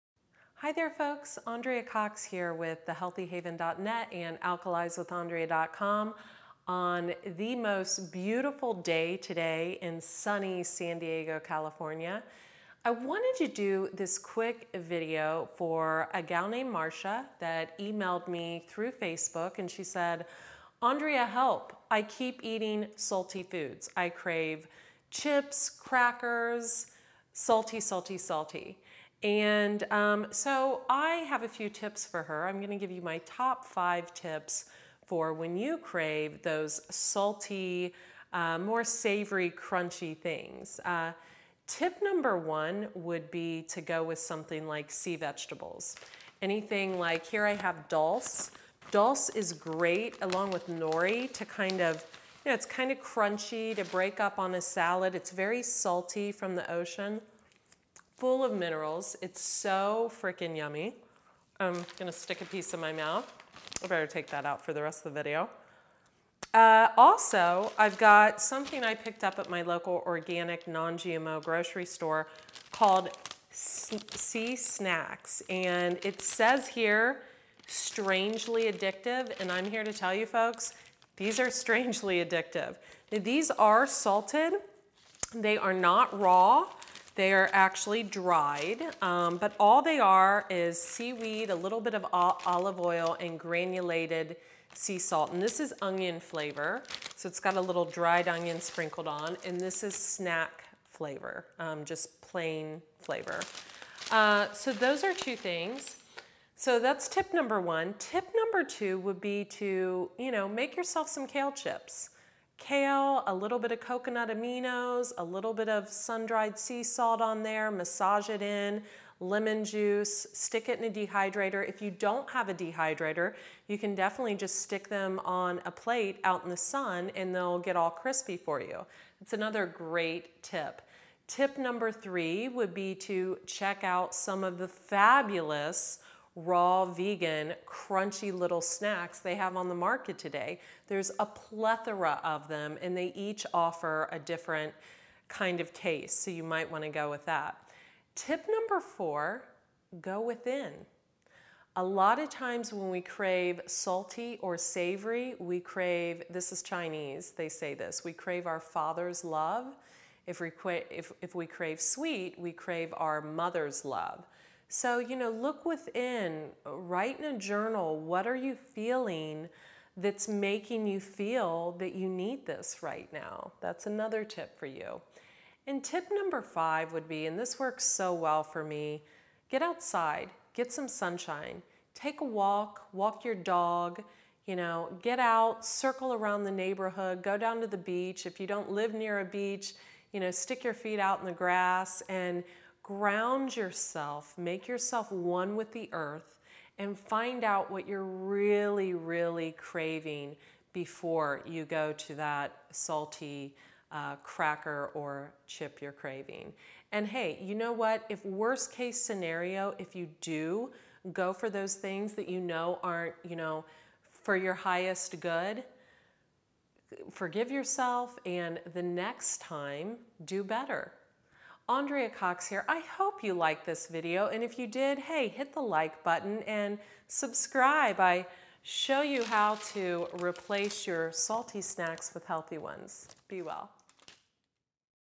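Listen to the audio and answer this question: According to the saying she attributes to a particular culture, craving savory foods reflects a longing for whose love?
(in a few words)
Father's love.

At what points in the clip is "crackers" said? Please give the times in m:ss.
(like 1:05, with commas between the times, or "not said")
0:25, 3:24.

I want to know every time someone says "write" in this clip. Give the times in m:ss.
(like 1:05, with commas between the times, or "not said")
2:46.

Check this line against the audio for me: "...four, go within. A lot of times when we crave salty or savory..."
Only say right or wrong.
right.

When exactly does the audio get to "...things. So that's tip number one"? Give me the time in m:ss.
1:45.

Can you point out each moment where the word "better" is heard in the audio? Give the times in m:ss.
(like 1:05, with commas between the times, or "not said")
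1:03, 3:40.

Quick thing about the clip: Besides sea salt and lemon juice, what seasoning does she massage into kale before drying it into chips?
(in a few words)
Coconut aminos.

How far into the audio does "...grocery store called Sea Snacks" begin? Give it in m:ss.
1:11.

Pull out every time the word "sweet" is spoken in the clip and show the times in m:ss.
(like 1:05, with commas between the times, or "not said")
2:41.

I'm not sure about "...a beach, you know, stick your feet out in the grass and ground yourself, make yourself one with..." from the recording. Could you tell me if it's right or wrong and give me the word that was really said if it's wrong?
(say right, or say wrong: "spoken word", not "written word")
right.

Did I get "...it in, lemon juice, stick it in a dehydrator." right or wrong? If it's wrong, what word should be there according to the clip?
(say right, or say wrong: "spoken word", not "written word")
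right.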